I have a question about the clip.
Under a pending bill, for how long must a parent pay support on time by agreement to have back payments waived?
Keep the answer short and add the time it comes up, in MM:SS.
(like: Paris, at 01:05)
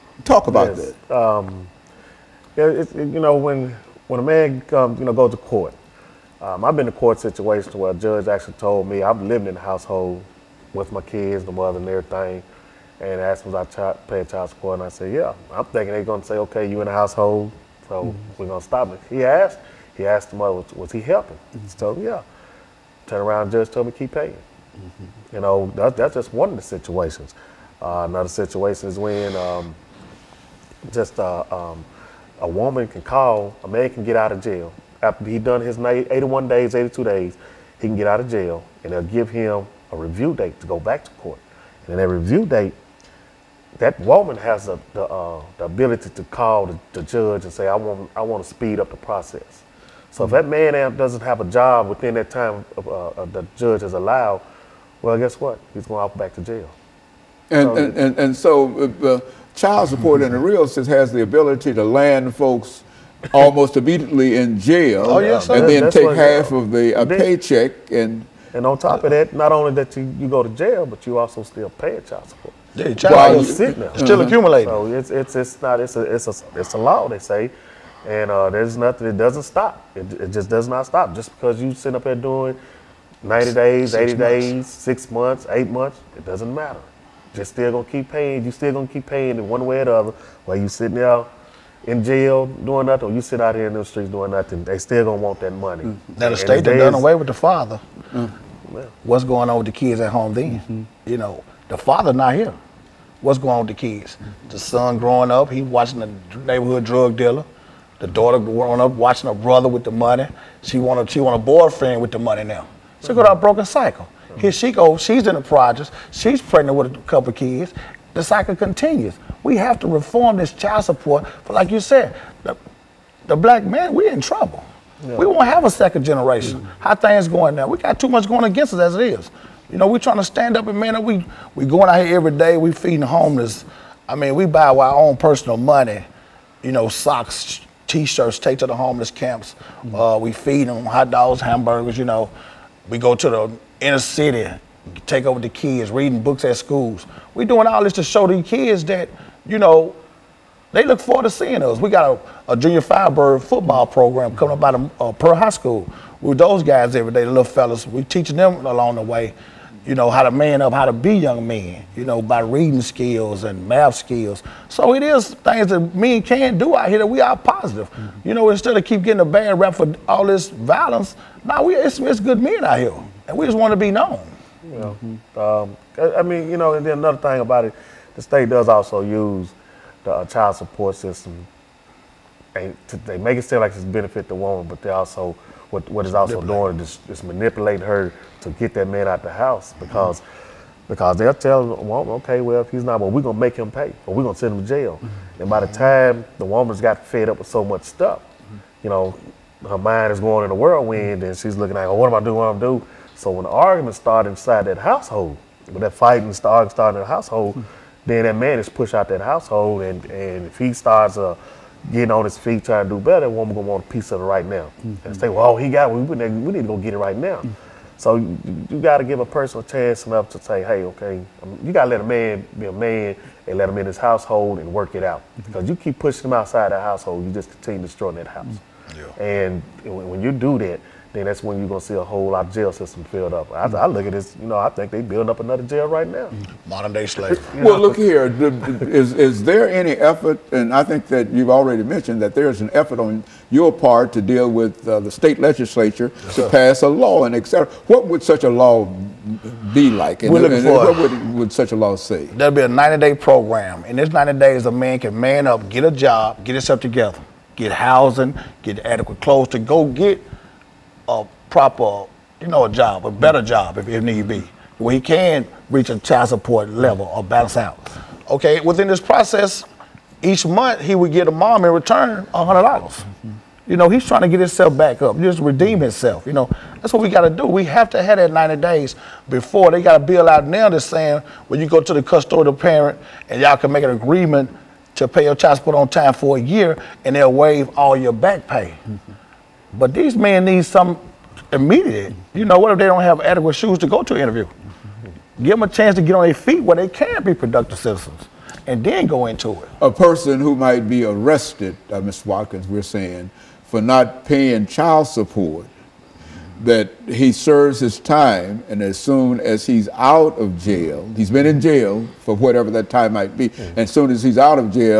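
a year, at 04:46.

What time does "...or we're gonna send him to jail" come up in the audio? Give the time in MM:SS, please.
03:14.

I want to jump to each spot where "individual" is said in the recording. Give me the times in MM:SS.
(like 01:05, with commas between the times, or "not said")
not said.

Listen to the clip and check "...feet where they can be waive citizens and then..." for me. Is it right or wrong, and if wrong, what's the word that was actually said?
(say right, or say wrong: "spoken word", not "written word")
wrong: "productive", not "waive".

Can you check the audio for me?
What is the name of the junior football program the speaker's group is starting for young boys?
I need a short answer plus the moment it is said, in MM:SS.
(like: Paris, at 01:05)
Junior Firebird, at 02:32.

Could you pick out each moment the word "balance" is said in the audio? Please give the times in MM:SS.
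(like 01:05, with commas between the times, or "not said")
04:27.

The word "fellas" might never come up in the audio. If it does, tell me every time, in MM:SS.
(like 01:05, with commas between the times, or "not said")
02:37.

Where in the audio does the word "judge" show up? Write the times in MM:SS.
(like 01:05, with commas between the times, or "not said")
00:07, 00:23, 00:47, 00:53.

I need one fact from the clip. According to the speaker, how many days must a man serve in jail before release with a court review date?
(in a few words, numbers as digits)
81.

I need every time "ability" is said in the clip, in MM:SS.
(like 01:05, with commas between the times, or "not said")
00:45, 01:01.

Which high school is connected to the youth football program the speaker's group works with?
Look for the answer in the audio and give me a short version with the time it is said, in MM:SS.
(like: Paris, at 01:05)
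Pearl High School, at 02:35.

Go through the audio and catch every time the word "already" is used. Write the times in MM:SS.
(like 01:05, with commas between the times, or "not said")
04:01.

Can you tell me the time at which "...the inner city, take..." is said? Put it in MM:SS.
02:23.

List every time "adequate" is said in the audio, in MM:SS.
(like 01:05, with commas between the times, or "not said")
04:18, 04:53.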